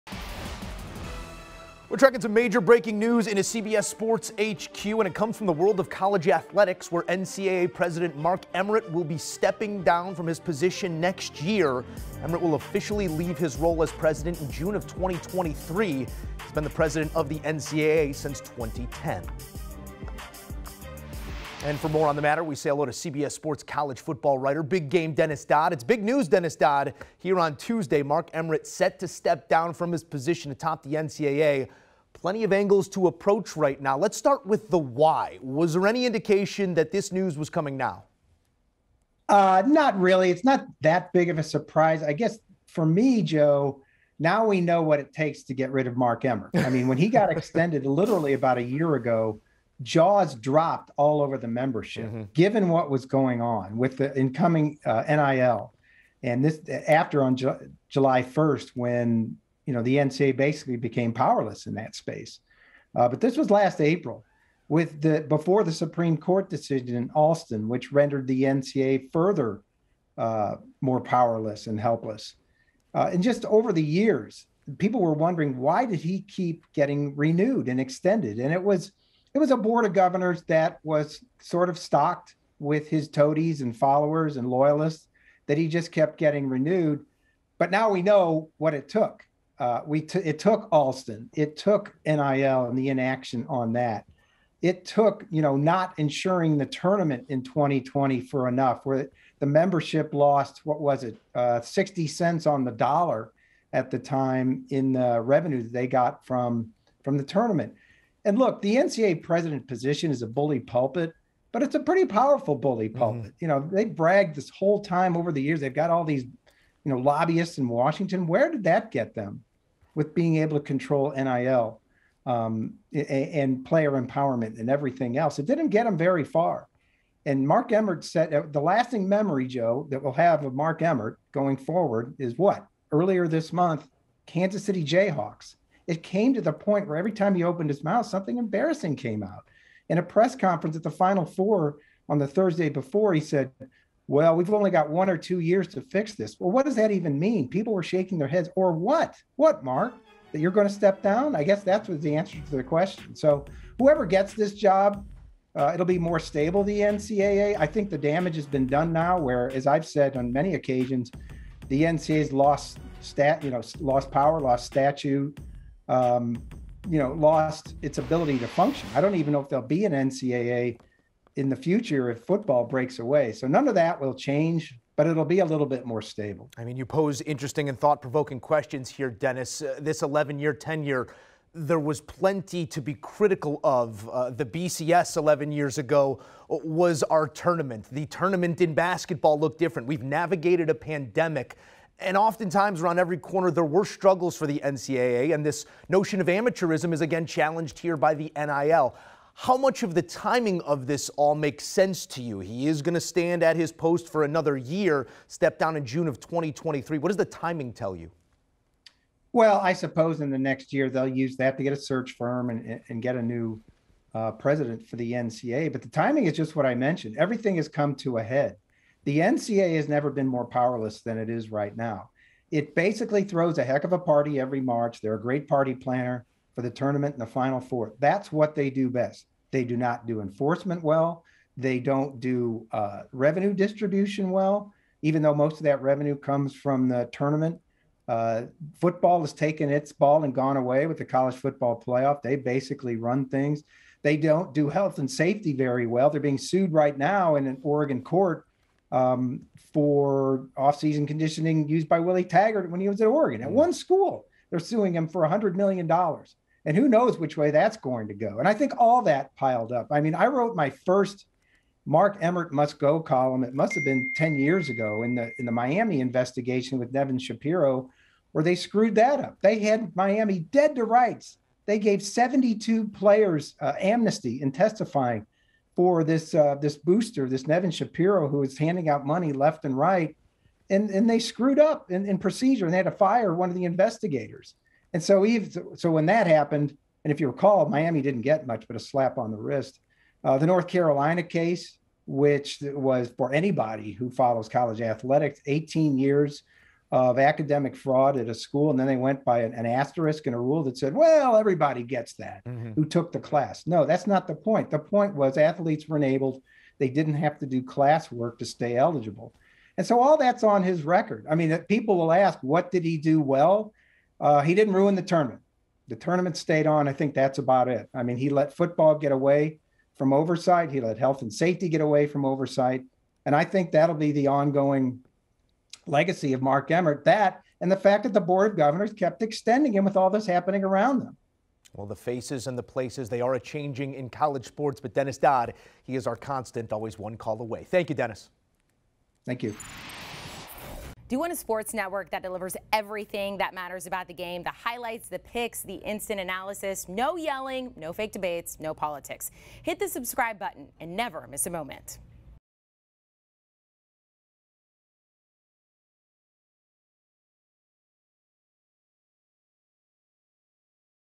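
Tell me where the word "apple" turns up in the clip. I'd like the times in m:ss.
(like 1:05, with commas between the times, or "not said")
not said.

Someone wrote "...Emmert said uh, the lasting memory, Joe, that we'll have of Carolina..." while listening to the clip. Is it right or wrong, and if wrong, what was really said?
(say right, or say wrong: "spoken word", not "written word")
wrong: "Mark", not "Carolina".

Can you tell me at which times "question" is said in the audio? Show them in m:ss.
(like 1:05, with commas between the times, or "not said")
2:32, 2:58.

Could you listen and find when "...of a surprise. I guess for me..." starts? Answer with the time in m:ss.
0:41.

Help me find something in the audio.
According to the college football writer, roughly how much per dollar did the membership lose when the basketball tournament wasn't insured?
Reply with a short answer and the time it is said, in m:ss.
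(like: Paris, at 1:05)
60 cents, at 1:41.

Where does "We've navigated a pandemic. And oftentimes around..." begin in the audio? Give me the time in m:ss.
3:09.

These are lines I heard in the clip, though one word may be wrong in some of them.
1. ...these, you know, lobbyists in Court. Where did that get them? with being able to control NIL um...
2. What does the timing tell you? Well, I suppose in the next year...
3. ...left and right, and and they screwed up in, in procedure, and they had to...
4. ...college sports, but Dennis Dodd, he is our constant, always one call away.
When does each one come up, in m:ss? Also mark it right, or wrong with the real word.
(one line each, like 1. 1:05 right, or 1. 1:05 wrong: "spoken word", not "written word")
1. 1:56 wrong: "Washington", not "Court"
2. 3:26 right
3. 4:39 right
4. 5:34 right.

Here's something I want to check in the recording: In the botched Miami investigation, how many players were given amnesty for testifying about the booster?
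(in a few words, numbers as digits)
72.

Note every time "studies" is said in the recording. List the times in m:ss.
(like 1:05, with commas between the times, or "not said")
not said.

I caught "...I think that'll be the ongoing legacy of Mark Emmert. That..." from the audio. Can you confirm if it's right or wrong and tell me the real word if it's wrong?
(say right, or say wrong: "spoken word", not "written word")
right.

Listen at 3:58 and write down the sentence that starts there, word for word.
Uh, football has taken its ball and gone away with the college football playoff.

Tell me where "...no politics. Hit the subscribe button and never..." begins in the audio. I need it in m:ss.
5:48.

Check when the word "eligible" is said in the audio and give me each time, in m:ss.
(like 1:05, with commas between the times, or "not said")
5:08.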